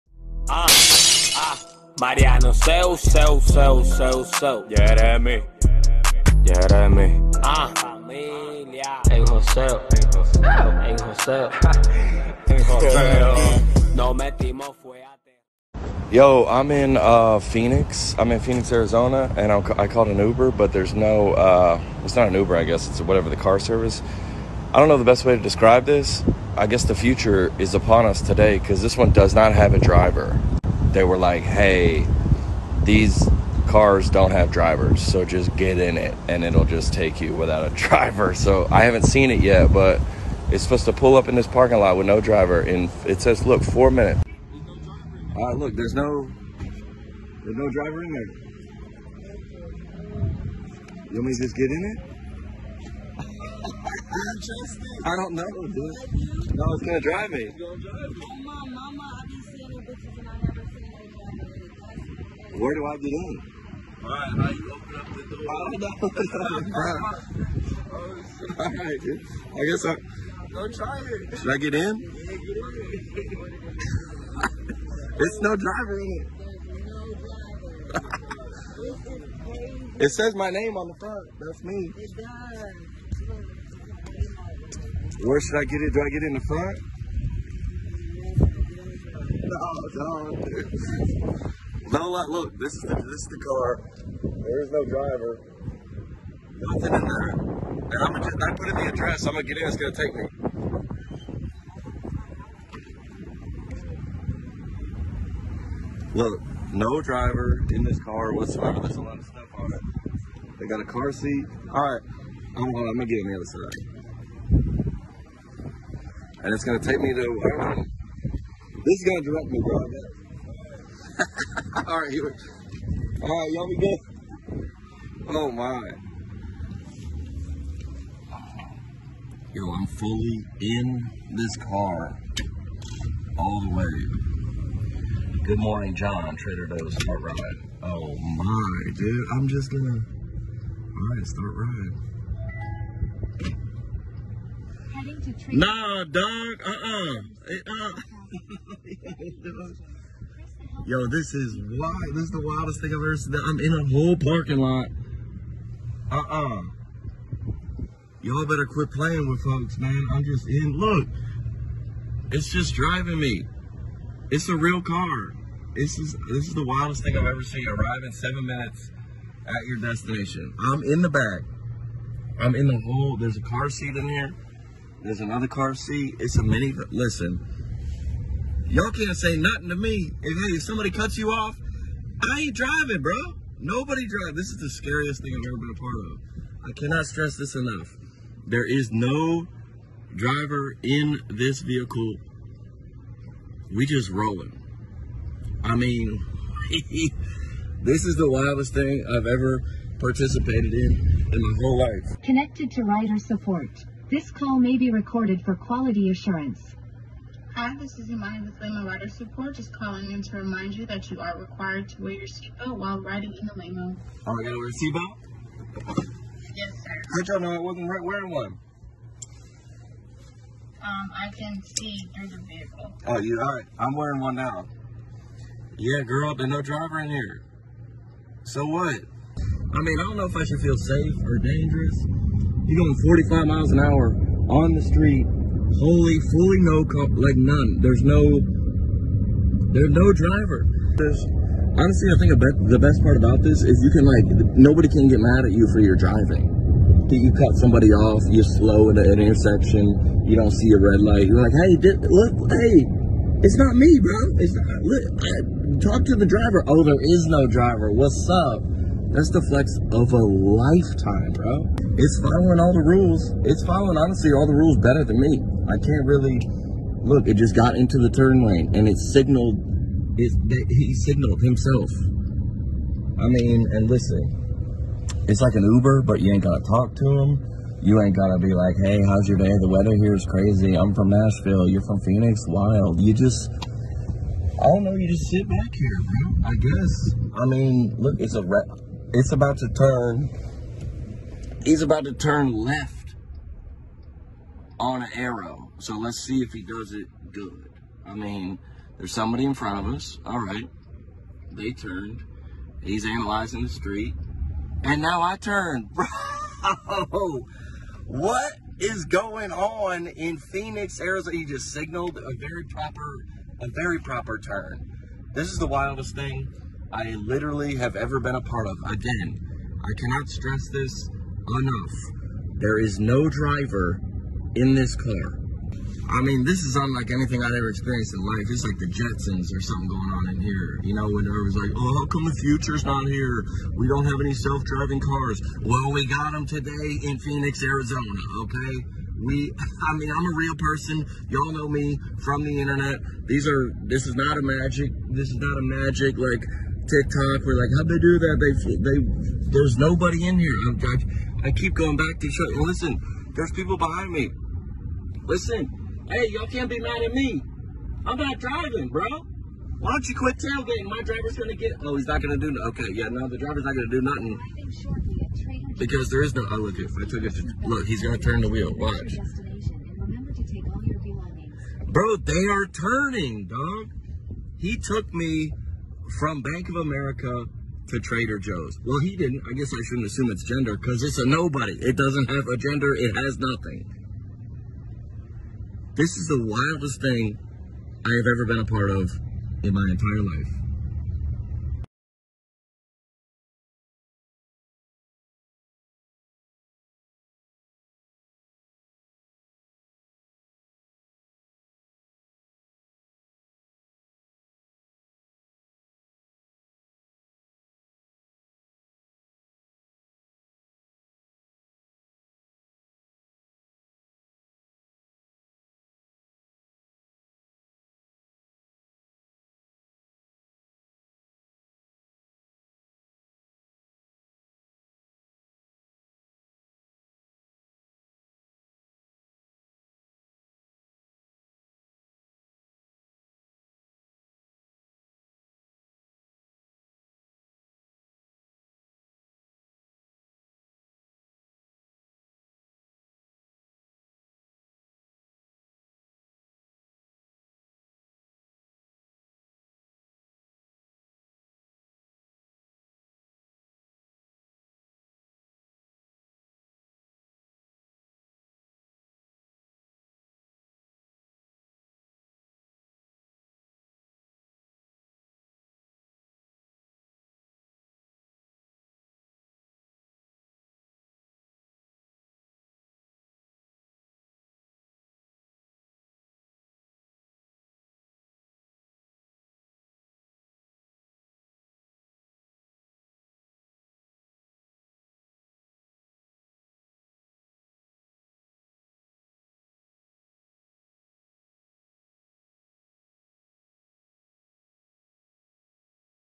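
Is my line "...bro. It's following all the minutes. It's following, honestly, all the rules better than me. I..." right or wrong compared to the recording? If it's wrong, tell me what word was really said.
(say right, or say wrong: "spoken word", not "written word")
wrong: "rules", not "minutes".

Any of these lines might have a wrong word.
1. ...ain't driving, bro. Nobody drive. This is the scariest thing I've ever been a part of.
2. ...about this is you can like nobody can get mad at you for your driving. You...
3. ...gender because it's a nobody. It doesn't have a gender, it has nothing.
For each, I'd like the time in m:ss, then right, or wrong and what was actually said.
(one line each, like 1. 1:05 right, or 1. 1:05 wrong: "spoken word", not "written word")
1. 3:02 right
2. 4:03 right
3. 6:20 right.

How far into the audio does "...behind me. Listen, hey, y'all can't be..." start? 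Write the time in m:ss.
5:53.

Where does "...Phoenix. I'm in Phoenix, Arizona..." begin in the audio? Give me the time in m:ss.
0:17.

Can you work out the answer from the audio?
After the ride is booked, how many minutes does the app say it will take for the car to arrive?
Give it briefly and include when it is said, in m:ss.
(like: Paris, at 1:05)
4, at 0:43.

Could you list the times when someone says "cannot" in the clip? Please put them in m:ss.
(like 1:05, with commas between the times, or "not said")
3:06, 5:19.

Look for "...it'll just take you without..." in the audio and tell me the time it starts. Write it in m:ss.
0:36.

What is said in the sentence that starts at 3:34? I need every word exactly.
Oh, I gotta wear a seatbelt?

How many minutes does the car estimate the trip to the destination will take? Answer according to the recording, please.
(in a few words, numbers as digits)
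7.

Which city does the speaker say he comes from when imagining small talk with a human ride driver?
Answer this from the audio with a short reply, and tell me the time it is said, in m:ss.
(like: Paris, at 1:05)
Nashville, at 4:40.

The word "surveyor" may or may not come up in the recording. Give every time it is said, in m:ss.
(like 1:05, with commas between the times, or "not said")
not said.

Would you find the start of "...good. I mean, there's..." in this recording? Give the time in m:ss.
4:57.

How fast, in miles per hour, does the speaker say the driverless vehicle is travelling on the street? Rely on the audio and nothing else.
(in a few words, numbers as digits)
45.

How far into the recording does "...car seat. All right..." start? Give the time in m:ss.
1:50.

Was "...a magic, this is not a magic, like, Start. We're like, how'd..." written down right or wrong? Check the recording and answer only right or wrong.
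wrong.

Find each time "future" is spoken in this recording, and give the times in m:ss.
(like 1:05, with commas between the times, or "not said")
0:26, 5:32.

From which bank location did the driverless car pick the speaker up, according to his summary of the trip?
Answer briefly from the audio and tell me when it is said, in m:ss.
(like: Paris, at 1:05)
Bank of America, at 6:16.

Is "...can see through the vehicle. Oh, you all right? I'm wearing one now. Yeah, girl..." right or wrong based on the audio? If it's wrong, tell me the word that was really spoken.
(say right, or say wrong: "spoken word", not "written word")
right.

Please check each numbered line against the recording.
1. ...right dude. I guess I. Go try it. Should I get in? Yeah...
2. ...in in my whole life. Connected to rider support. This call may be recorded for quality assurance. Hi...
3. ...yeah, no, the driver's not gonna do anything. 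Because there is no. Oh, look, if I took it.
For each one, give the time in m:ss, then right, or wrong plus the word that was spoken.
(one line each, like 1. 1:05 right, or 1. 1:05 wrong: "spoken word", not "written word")
1. 1:08 right
2. 3:20 right
3. 6:02 wrong: "nothing", not "anything".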